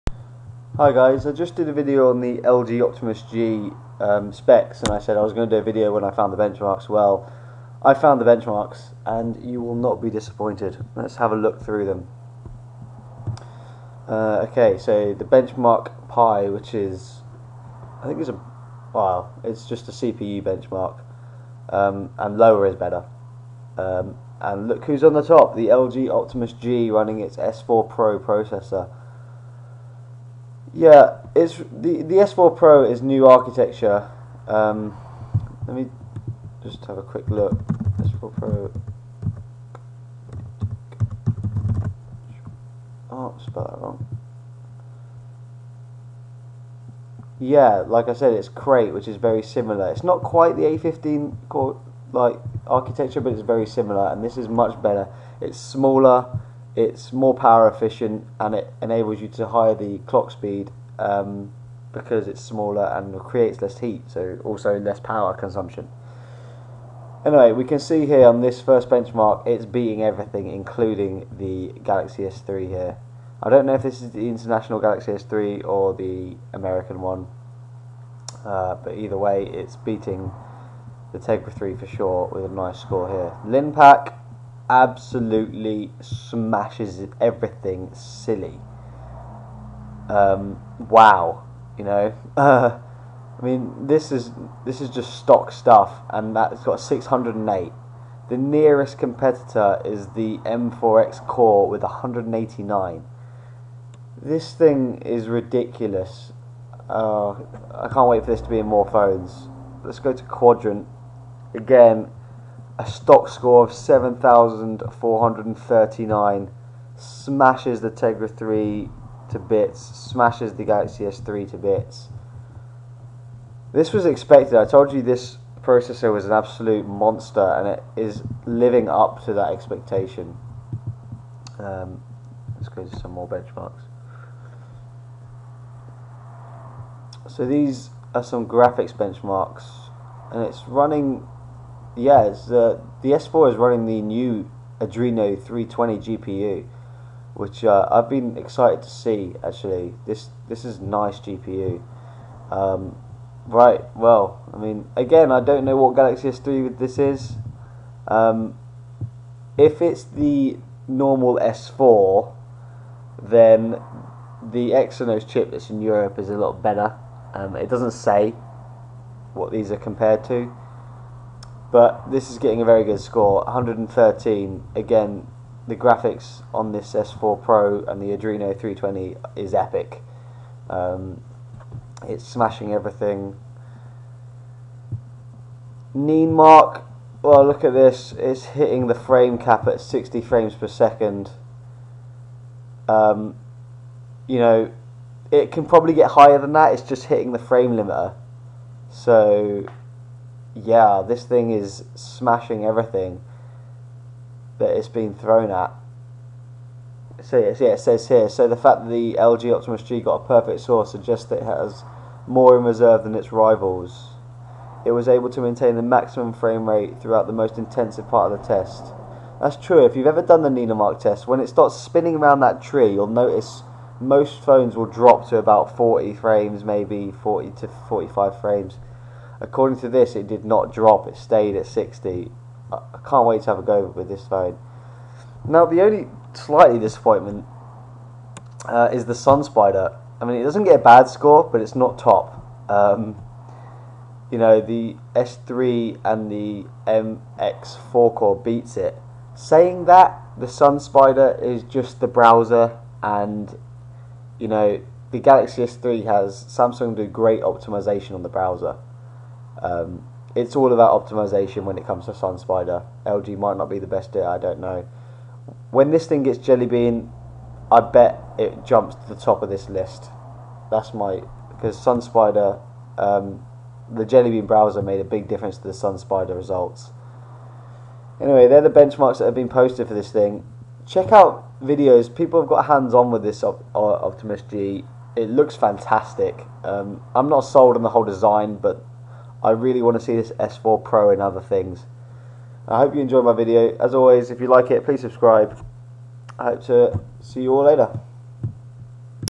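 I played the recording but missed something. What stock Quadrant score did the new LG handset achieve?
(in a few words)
7,439.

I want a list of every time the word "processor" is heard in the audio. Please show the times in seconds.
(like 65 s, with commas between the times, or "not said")
28 s, 125 s.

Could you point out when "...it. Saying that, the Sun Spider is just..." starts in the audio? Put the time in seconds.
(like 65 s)
248 s.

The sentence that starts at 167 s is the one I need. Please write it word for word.
Um, it doesn't say what these are compared to.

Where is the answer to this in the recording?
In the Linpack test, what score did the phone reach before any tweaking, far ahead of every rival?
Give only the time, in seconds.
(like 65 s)
96 s.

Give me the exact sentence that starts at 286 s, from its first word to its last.
Um, I'm not sold on the whole design, but I really want to see this S4 Pro and other things.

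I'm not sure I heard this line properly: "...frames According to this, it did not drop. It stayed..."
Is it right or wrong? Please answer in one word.
right.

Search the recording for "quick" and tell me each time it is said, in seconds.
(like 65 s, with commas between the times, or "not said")
37 s.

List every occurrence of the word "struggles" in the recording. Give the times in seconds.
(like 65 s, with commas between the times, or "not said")
not said.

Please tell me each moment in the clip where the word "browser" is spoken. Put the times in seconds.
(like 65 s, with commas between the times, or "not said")
252 s, 258 s, 274 s.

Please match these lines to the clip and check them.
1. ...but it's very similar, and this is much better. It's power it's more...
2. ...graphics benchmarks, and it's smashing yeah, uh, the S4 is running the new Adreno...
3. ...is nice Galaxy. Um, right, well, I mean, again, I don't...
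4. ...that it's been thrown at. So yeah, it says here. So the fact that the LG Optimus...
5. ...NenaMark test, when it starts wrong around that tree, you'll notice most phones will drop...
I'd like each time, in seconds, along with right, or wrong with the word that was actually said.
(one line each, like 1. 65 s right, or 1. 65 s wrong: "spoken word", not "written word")
1. 53 s wrong: "smaller", not "power"
2. 138 s wrong: "running", not "smashing"
3. 150 s wrong: "GPU", not "Galaxy"
4. 204 s right
5. 220 s wrong: "spinning", not "wrong".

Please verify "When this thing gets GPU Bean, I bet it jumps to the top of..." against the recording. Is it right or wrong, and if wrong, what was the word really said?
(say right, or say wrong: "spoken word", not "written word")
wrong: "Jelly", not "GPU".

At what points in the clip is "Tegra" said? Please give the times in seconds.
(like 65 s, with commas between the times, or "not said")
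81 s, 117 s.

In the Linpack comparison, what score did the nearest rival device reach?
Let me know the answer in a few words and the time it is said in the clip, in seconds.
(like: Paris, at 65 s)
189, at 101 s.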